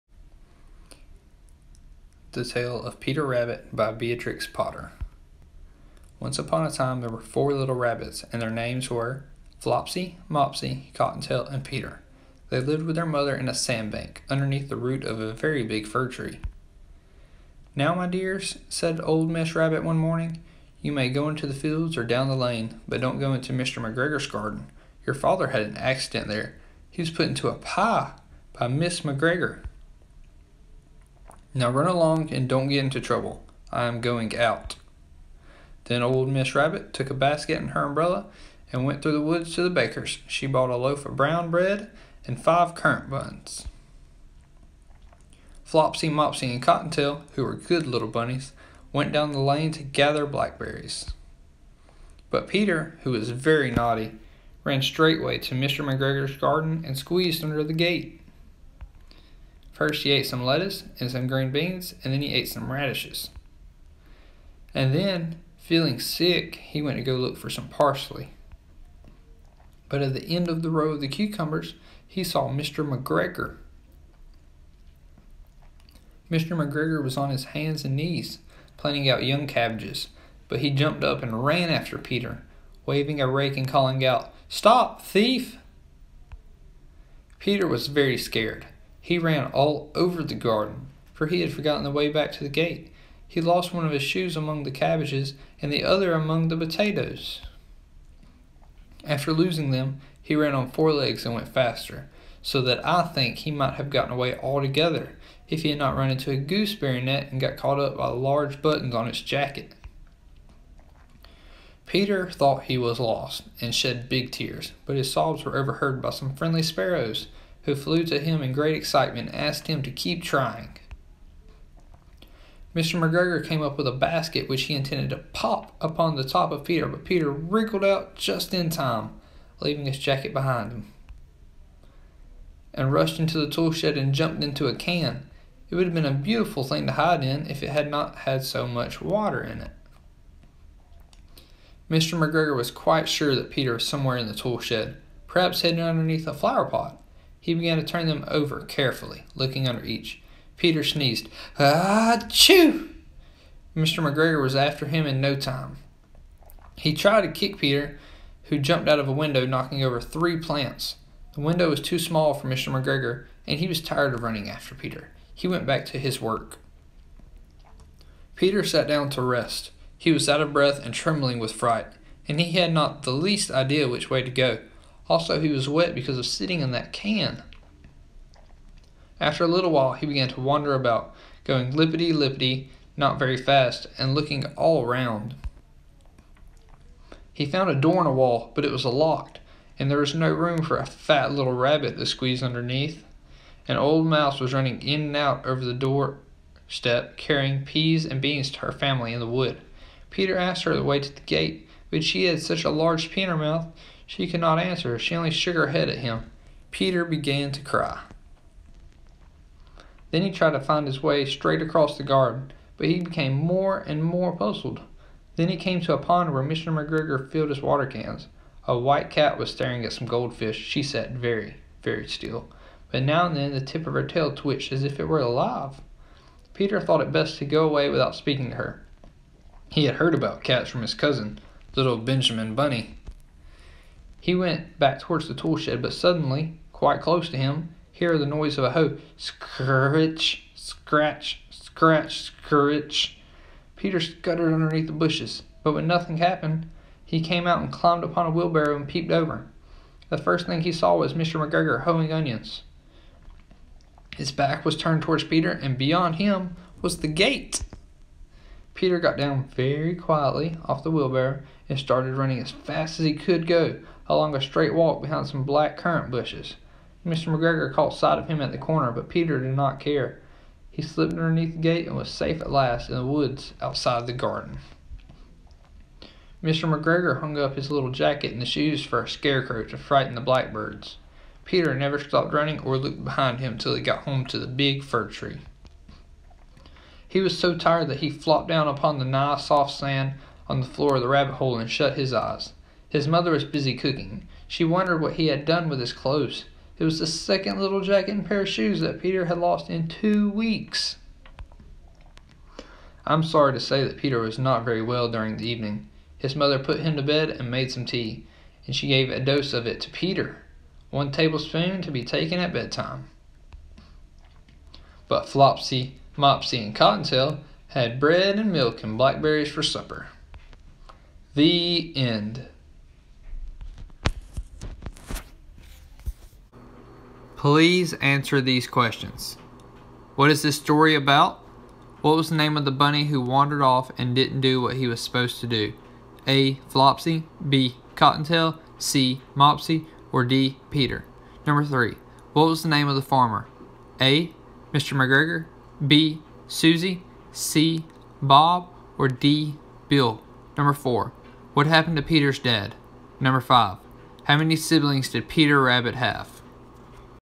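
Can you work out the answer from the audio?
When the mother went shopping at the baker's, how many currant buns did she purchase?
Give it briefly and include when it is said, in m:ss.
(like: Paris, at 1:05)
5, at 0:42.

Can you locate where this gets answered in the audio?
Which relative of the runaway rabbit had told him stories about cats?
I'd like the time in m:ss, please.
3:51.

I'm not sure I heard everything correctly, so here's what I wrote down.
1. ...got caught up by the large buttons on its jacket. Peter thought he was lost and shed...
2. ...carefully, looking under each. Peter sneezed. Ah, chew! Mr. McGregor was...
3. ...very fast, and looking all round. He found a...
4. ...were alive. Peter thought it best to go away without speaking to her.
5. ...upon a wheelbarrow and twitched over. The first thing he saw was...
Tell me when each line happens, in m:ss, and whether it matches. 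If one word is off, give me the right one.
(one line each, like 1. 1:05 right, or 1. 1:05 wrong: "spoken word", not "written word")
1. 1:47 right
2. 2:28 right
3. 3:03 right
4. 3:45 right
5. 4:08 wrong: "peeped", not "twitched".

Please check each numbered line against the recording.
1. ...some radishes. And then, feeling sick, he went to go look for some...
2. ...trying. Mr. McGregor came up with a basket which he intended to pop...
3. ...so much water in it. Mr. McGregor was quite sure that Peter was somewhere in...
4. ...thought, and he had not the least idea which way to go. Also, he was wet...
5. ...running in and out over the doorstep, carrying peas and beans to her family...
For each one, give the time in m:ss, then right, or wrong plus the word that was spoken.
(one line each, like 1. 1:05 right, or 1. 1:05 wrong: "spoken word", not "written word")
1. 1:02 right
2. 2:00 right
3. 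2:18 right
4. 2:51 wrong: "fright", not "thought"
5. 3:14 right.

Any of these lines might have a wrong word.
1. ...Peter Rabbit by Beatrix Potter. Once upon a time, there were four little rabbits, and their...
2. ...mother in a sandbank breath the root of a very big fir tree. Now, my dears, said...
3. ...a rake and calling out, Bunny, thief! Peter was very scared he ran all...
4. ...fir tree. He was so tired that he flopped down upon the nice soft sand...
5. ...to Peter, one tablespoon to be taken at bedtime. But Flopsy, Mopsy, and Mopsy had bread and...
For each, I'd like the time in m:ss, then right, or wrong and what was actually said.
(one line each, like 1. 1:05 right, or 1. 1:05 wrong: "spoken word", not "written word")
1. 0:03 right
2. 0:13 wrong: "underneath", not "breath"
3. 1:23 wrong: "Stop", not "Bunny"
4. 4:44 right
5. 5:09 wrong: "Cottontail", not "Mopsy".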